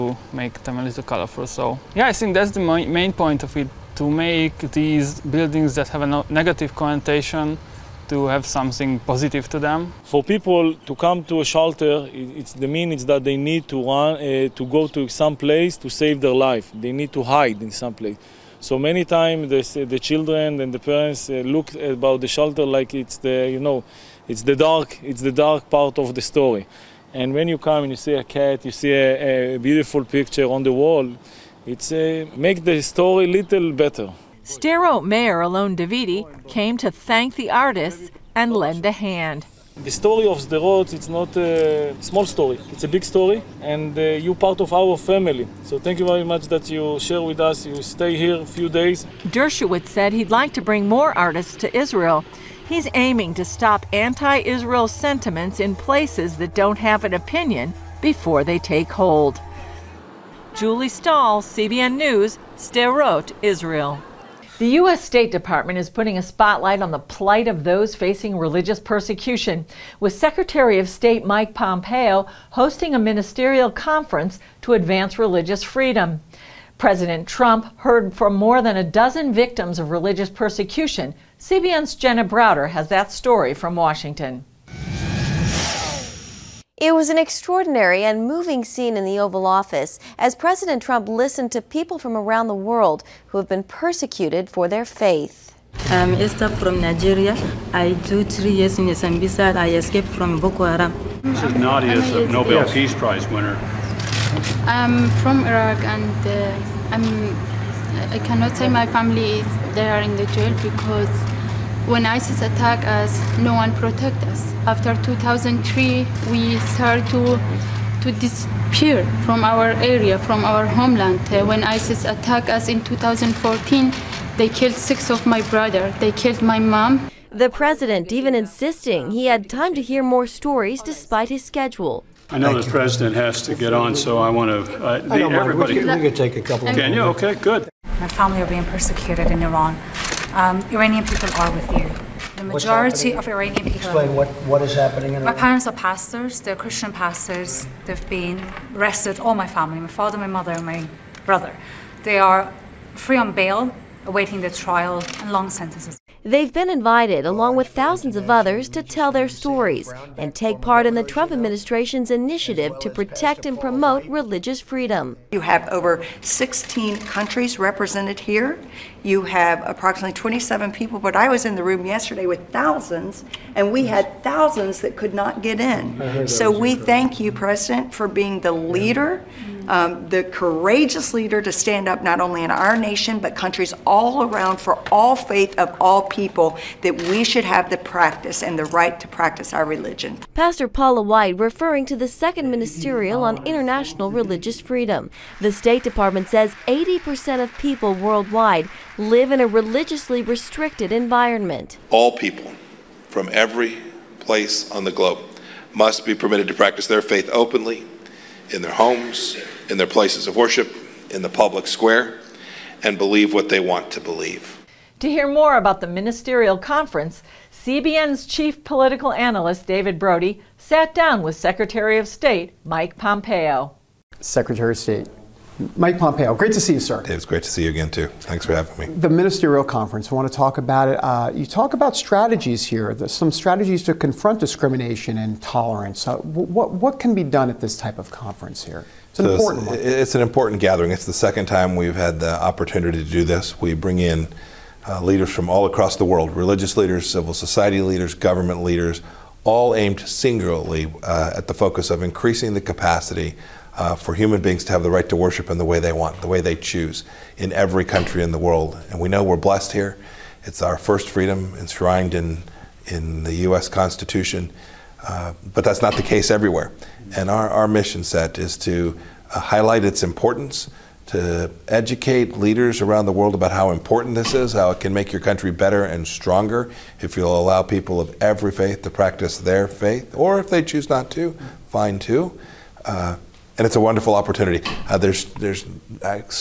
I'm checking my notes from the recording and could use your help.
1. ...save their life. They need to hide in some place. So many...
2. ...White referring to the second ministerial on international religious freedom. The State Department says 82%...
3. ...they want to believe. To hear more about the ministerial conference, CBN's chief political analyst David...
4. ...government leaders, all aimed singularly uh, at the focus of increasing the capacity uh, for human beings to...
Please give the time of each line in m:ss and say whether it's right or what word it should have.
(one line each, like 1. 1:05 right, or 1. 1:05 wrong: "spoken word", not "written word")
1. 0:15 right
2. 3:11 wrong: "80", not "82"
3. 3:33 right
4. 4:08 right.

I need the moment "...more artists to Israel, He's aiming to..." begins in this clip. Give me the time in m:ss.
0:50.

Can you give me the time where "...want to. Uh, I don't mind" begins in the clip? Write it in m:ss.
2:14.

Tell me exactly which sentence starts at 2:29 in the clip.
All my family, my father, my mother, my brother.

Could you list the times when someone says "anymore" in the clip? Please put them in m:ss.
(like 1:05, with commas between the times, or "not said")
not said.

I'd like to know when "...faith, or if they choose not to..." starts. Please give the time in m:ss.
4:39.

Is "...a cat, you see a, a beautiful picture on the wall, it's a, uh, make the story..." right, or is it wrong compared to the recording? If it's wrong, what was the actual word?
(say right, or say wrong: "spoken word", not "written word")
right.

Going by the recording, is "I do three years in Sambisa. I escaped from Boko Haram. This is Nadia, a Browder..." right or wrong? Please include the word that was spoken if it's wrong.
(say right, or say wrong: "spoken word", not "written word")
wrong: "Nobel", not "Browder".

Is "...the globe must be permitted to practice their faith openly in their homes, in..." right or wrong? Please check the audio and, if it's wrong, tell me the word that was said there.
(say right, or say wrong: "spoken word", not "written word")
right.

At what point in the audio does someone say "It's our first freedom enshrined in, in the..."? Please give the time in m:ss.
4:20.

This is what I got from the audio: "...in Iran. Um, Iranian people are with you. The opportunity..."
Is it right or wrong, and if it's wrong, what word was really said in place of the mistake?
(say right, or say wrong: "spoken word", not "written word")
wrong: "majority", not "opportunity".